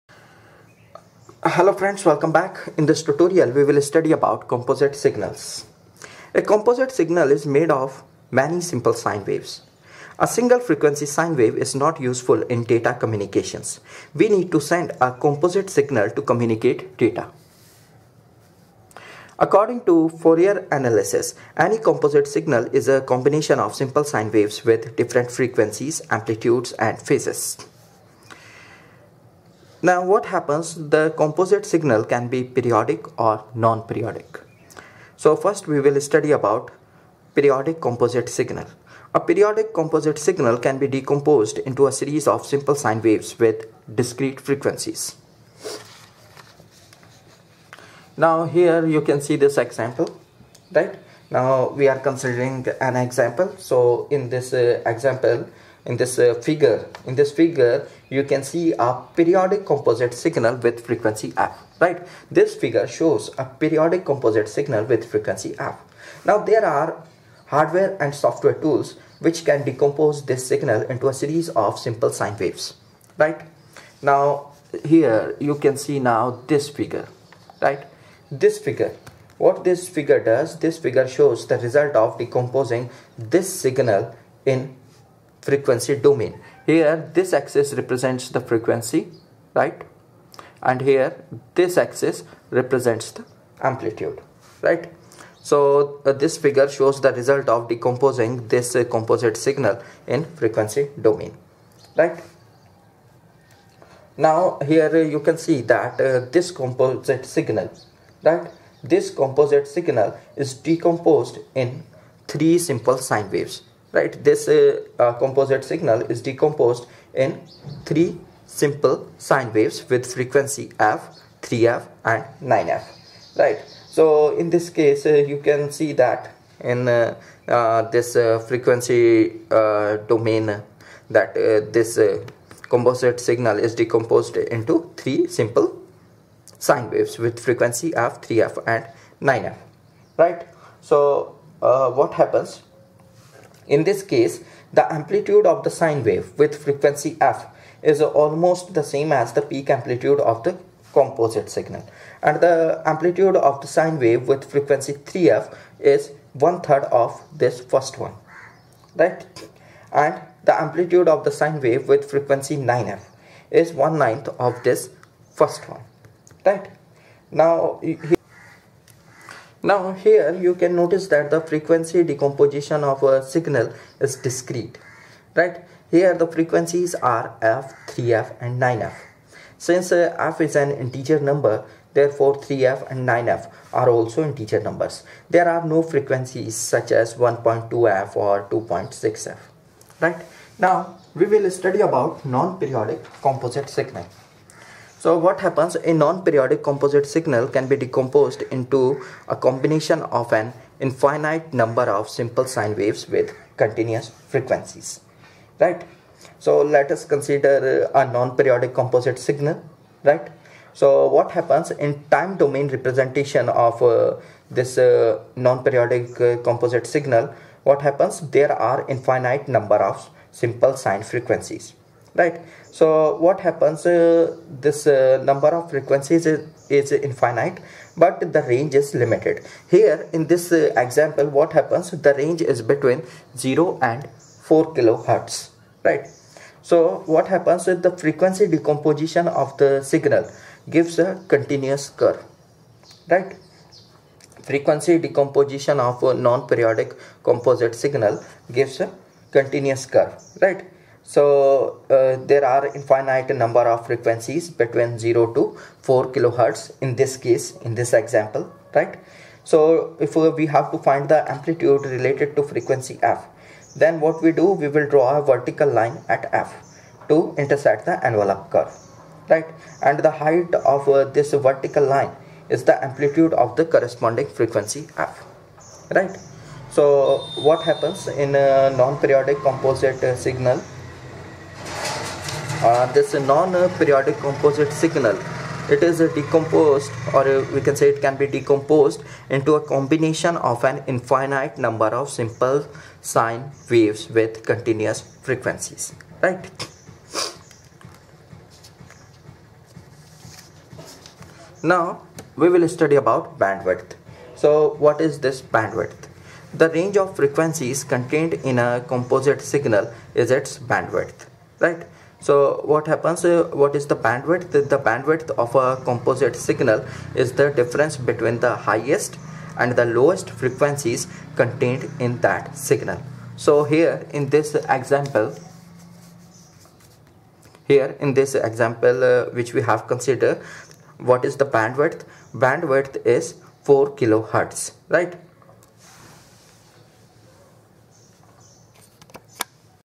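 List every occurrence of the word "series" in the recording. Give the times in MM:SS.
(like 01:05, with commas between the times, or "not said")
00:41, 01:11.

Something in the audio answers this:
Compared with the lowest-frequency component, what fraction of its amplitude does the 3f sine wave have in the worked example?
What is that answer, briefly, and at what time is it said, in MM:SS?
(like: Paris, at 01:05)
one third, at 02:36.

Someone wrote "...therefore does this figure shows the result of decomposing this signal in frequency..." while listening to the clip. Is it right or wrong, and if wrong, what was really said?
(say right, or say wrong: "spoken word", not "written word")
wrong: "figure", not "therefore".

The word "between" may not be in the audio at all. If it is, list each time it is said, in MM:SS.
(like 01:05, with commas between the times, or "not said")
03:52, 04:14, 05:17.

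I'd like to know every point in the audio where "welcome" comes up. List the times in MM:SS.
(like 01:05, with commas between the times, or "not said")
00:02.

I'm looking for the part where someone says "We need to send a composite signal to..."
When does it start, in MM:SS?
00:14.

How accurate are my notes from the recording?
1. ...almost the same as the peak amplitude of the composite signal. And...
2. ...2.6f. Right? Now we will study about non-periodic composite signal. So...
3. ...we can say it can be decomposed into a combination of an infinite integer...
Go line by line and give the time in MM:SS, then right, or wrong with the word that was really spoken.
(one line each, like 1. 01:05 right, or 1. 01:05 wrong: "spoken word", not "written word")
1. 02:28 right
2. 03:08 right
3. 04:47 wrong: "number", not "integer".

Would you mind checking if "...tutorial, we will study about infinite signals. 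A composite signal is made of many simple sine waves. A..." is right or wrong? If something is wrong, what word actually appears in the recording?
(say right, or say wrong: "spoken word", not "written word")
wrong: "composite", not "infinite".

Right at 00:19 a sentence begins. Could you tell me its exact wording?
According to Fourier analysis, any composite signal is a combination of simple sine waves with different frequencies, amplitudes, and phases.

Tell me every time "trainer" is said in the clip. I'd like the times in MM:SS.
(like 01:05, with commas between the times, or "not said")
not said.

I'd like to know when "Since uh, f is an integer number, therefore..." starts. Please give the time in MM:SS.
02:59.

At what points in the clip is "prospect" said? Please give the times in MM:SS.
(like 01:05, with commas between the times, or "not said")
not said.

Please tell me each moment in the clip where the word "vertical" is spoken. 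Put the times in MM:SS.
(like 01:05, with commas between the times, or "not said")
04:25, 04:31.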